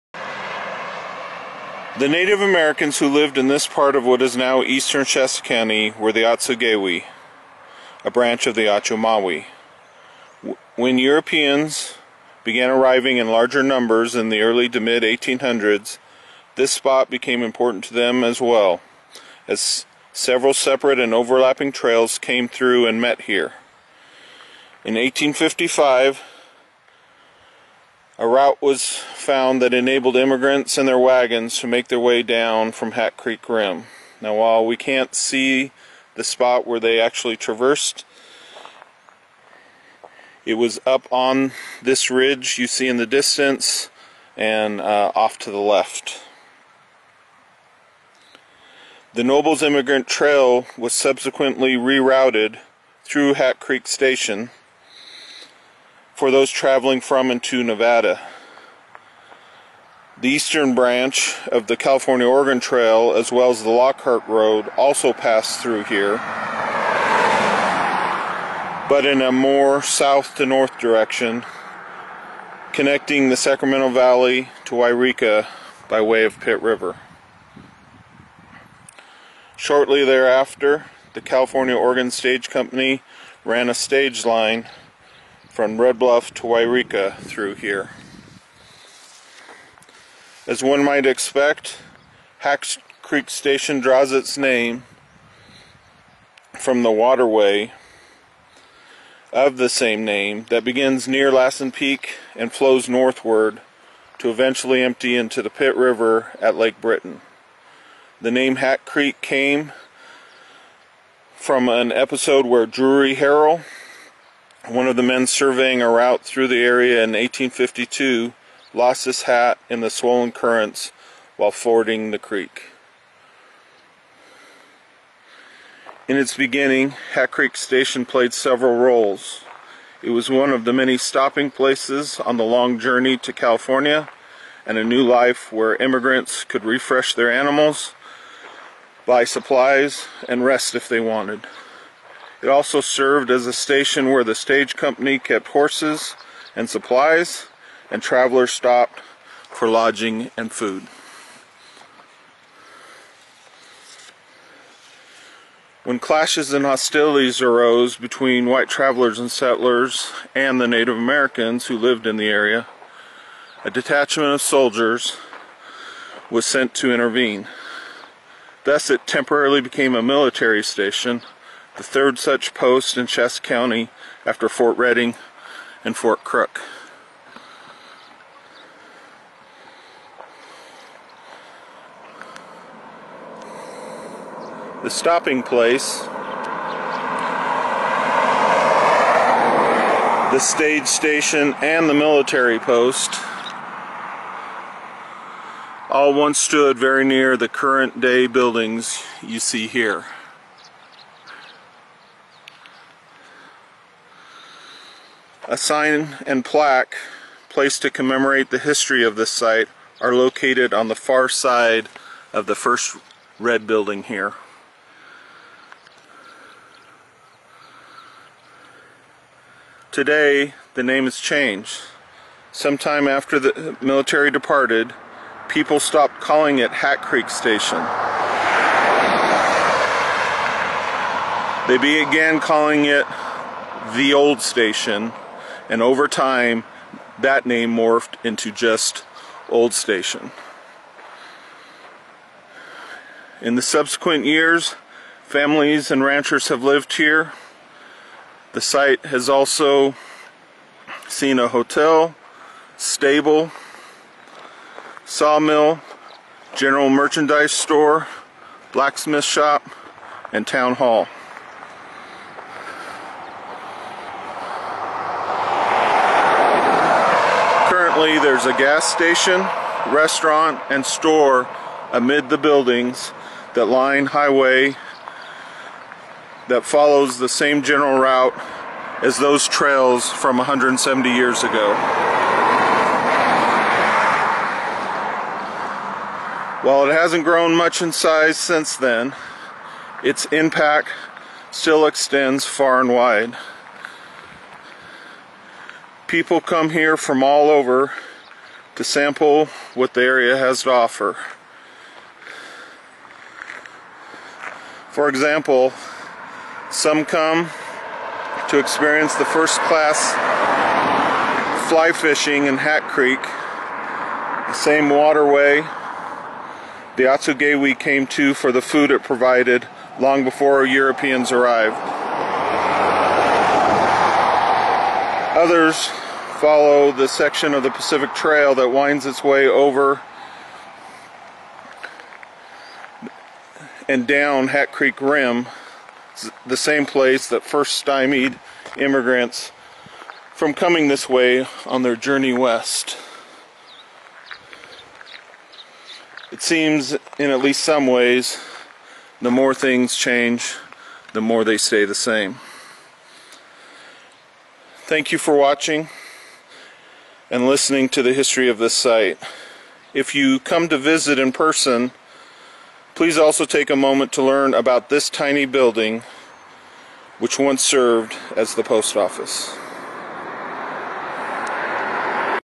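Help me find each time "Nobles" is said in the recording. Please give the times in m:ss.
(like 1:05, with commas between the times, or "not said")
0:49.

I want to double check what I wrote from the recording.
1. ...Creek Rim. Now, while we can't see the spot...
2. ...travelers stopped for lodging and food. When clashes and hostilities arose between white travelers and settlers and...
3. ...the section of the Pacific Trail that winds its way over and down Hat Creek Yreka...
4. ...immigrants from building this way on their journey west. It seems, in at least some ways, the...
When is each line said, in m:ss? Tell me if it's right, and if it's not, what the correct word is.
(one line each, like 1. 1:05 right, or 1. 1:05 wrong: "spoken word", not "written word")
1. 0:33 right
2. 2:28 right
3. 5:26 wrong: "Rim", not "Yreka"
4. 5:38 wrong: "coming", not "building".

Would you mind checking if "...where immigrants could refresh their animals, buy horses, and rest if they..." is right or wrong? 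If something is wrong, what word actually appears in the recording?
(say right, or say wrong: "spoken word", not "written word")
wrong: "supplies", not "horses".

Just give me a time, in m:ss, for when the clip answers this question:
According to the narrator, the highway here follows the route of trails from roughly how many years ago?
4:40.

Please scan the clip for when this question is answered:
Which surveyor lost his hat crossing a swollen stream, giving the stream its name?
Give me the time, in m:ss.
1:52.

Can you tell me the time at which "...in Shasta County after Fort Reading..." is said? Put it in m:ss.
2:52.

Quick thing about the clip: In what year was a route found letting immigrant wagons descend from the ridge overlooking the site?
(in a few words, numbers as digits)
1855.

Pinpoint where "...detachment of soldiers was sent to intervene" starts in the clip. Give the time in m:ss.
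2:43.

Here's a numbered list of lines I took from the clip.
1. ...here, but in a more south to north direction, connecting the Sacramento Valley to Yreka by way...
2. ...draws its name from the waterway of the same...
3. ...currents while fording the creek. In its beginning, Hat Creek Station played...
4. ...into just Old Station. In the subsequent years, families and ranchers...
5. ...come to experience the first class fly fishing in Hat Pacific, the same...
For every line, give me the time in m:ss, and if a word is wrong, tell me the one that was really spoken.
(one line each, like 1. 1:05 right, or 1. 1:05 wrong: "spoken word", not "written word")
1. 1:05 right
2. 1:33 right
3. 2:00 right
4. 3:58 right
5. 5:07 wrong: "Creek", not "Pacific".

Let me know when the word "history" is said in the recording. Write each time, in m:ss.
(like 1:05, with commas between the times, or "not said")
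3:28, 5:58.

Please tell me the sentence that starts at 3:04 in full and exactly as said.
The stopping place, the stage station, and the military post all once stood very near the current day buildings you see here.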